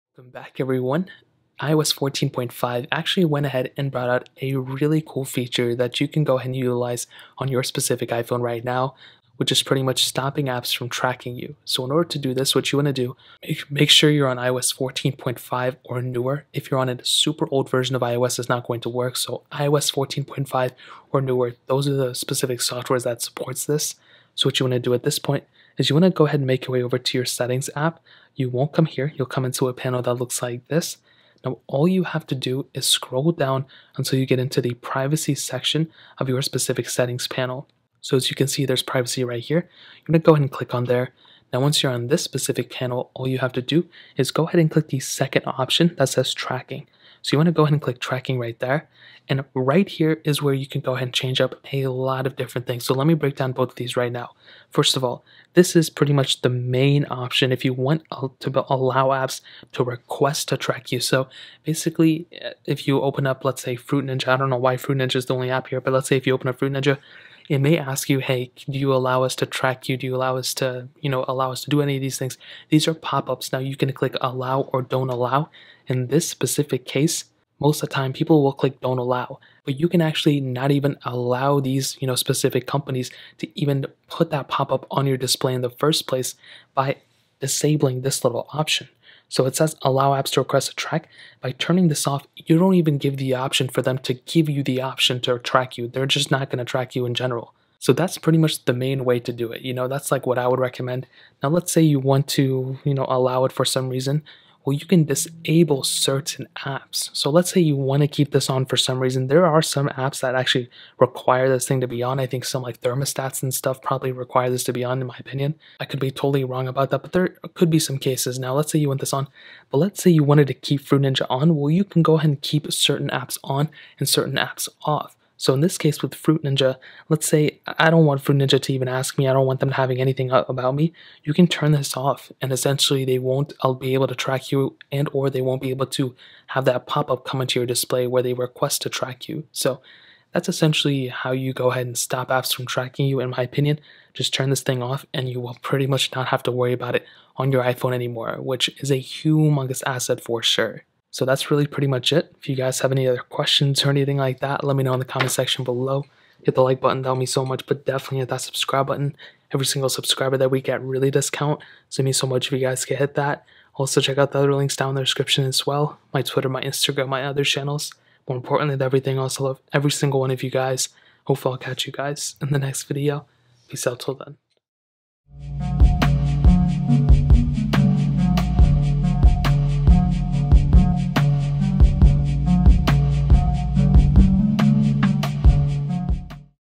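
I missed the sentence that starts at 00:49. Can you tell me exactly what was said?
And right here is where you can go ahead and change up a lot of different things.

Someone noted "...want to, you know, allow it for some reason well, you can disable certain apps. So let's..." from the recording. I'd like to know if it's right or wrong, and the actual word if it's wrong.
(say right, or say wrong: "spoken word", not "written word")
right.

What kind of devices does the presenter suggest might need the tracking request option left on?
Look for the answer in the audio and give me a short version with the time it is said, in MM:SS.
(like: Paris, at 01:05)
thermostats, at 01:52.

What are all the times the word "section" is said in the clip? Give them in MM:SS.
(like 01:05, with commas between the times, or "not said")
00:35, 02:35.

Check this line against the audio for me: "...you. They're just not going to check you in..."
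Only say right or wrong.
wrong.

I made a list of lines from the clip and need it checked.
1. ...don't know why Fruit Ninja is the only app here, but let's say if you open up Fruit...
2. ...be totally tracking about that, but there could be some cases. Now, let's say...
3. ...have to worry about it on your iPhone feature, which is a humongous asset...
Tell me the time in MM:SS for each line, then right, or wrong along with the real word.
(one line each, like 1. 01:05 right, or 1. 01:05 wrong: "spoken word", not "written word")
1. 01:04 right
2. 01:55 wrong: "wrong", not "tracking"
3. 02:26 wrong: "anymore", not "feature".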